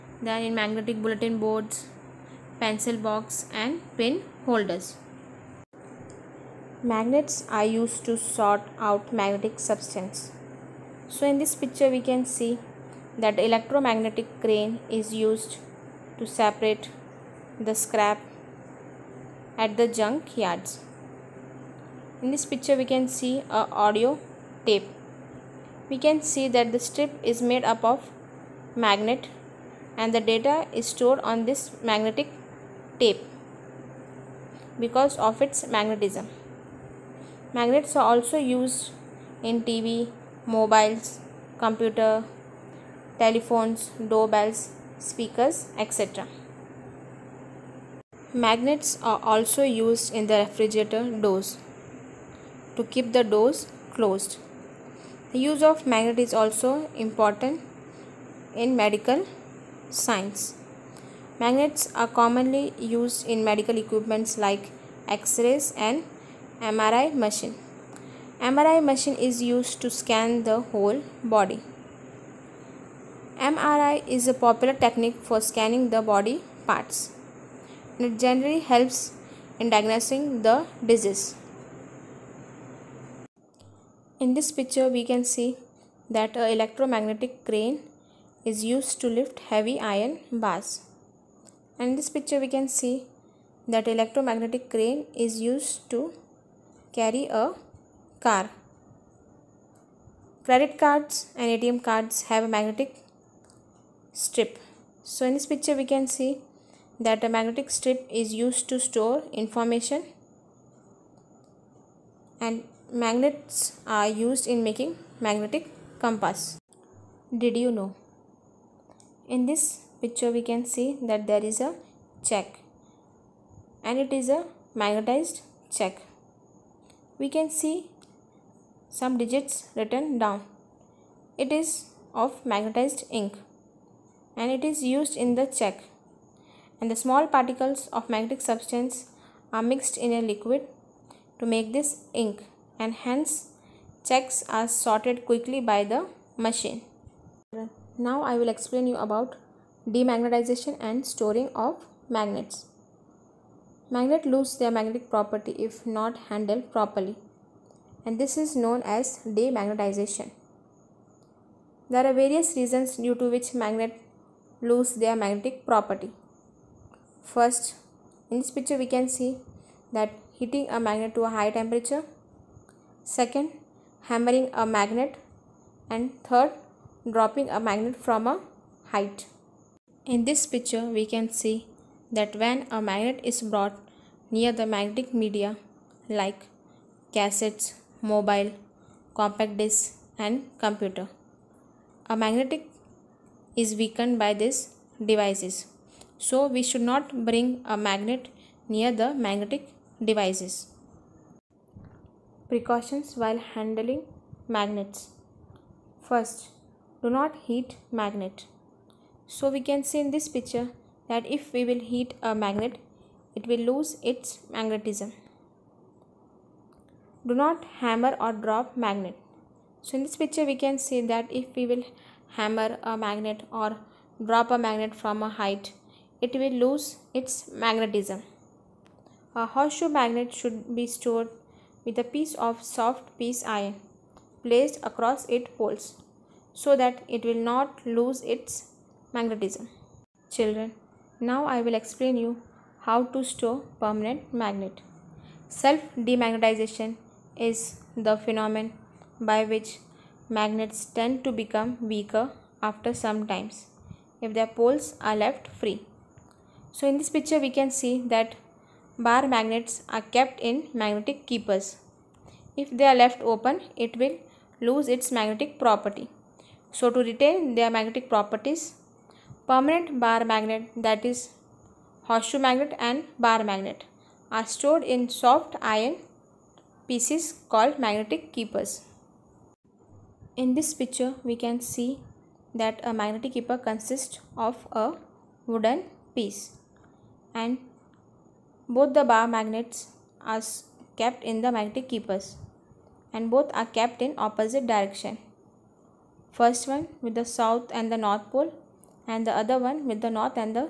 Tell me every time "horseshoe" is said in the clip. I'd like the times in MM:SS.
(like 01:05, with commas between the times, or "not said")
03:49, 04:32.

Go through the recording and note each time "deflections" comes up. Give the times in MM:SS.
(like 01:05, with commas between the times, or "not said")
not said.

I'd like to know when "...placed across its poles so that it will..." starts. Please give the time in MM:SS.
03:54.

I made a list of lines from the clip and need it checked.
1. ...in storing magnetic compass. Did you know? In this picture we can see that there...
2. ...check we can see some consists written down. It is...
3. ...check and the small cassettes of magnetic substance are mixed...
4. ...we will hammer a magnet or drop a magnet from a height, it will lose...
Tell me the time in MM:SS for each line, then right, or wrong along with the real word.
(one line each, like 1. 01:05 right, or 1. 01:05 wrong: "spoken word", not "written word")
1. 01:54 wrong: "making", not "storing"
2. 02:05 wrong: "digits", not "consists"
3. 02:15 wrong: "particles", not "cassettes"
4. 03:41 right.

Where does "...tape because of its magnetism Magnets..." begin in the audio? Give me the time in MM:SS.
00:33.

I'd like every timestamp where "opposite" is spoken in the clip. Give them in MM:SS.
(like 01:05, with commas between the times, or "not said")
04:54.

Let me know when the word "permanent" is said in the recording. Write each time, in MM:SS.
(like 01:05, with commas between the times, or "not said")
04:03, 04:29.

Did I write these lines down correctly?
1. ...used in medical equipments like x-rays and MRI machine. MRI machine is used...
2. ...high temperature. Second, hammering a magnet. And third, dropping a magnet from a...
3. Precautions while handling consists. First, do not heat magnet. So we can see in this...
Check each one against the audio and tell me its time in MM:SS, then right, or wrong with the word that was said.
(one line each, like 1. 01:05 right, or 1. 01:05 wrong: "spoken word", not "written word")
1. 01:02 right
2. 02:51 right
3. 03:22 wrong: "magnets", not "consists".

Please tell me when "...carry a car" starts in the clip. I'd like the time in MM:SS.
01:36.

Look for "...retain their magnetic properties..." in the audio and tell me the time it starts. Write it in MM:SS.
04:27.